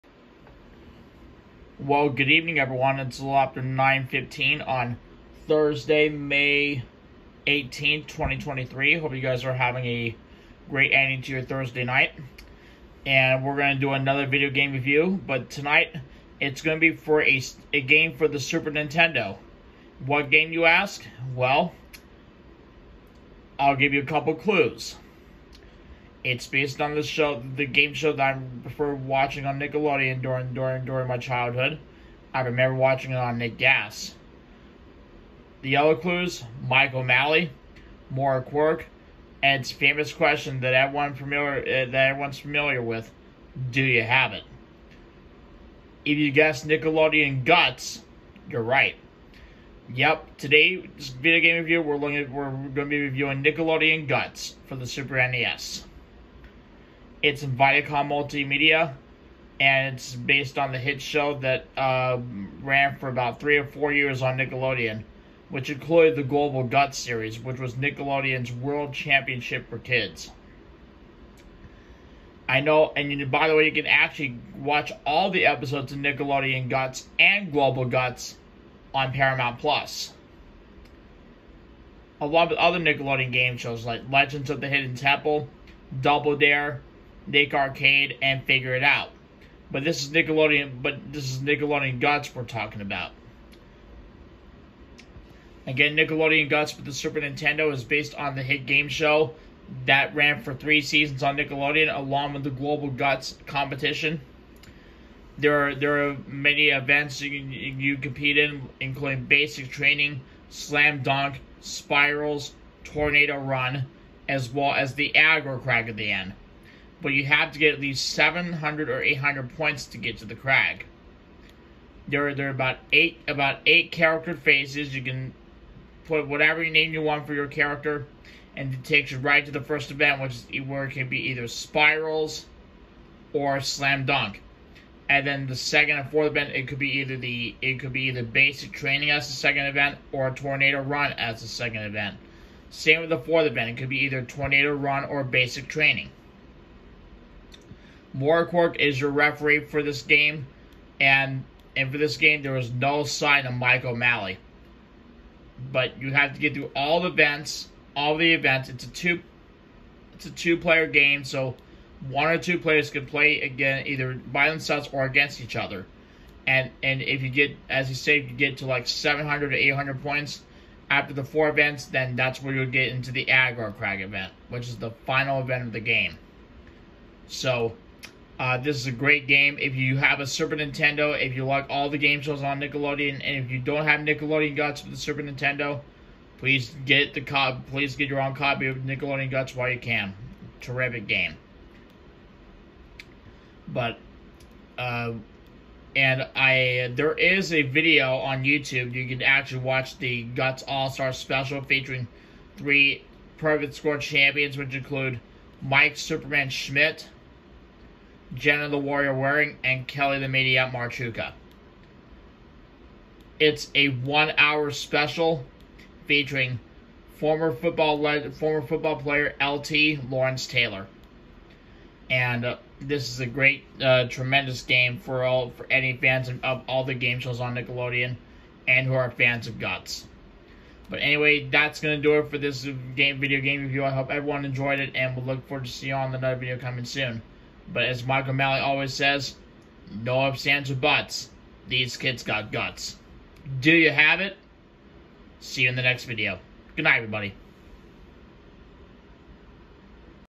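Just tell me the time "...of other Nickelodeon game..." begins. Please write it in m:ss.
1:22.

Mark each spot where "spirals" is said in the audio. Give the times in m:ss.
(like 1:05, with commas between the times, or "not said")
1:51, 2:11.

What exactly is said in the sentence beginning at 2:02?
There, there are about eight about eight character phases.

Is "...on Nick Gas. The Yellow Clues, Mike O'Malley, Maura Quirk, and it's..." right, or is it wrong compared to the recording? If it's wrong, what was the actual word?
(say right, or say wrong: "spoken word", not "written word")
right.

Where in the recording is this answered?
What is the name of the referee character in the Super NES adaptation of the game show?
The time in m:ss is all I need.
2:28.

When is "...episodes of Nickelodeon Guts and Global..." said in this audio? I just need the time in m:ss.
1:15.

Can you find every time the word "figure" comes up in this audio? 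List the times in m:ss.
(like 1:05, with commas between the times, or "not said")
1:28.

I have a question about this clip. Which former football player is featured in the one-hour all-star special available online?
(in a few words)
Lawrence Taylor.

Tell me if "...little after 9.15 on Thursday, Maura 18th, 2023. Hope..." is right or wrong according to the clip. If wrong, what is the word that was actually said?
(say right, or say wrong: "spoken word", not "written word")
wrong: "May", not "Maura".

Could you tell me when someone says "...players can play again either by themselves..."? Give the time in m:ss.
2:42.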